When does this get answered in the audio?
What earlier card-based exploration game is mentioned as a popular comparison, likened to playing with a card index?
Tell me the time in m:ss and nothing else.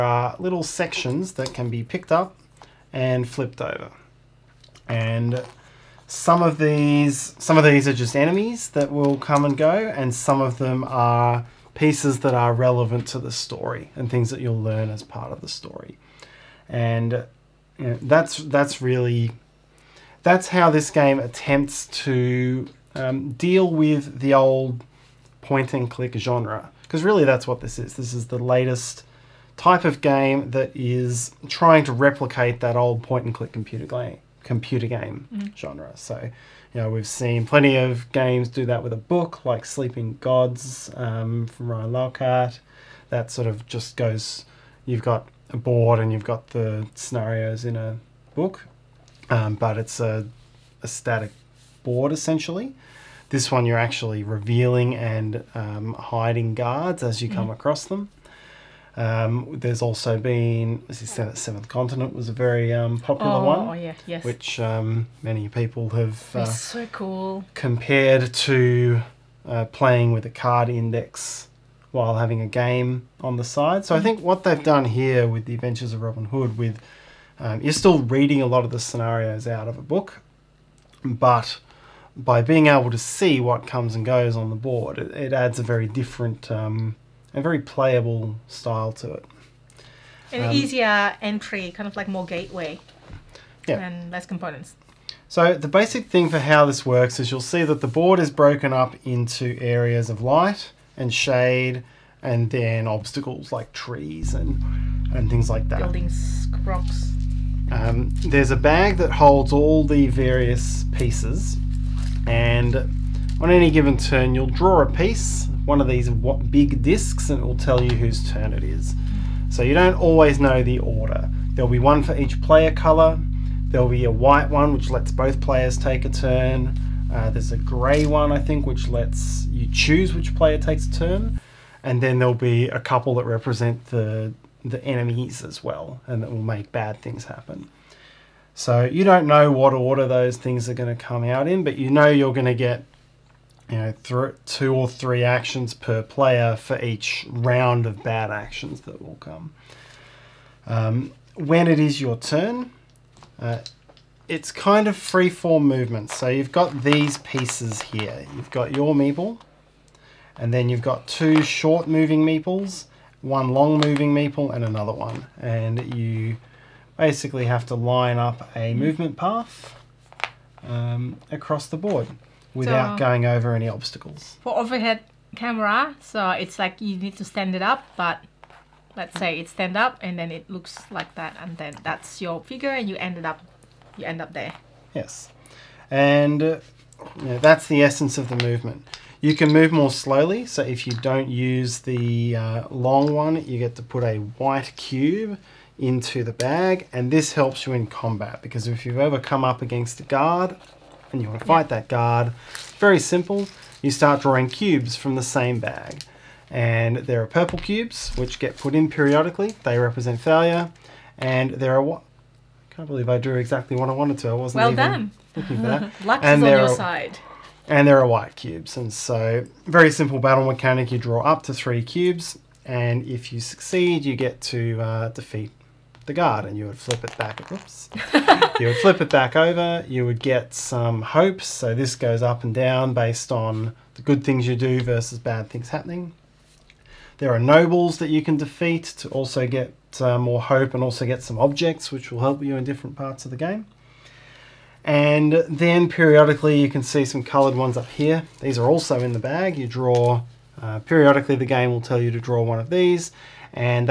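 1:01.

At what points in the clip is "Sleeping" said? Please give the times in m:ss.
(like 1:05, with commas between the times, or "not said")
0:39.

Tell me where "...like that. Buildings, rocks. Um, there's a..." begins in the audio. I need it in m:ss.
1:45.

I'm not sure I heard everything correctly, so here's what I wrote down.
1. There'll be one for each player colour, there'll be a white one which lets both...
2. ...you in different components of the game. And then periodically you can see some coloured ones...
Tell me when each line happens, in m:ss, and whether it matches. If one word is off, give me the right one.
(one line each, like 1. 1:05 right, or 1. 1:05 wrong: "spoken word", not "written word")
1. 2:01 right
2. 4:02 wrong: "parts", not "components".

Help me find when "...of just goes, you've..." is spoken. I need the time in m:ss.
0:43.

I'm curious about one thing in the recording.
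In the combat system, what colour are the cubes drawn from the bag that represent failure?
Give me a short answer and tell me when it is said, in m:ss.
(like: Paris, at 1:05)
purple, at 3:27.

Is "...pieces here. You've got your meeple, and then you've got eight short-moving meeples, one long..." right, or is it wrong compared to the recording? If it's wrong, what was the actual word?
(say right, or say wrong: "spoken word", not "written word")
wrong: "two", not "eight".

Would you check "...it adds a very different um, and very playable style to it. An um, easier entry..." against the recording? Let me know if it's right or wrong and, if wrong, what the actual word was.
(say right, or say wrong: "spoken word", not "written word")
right.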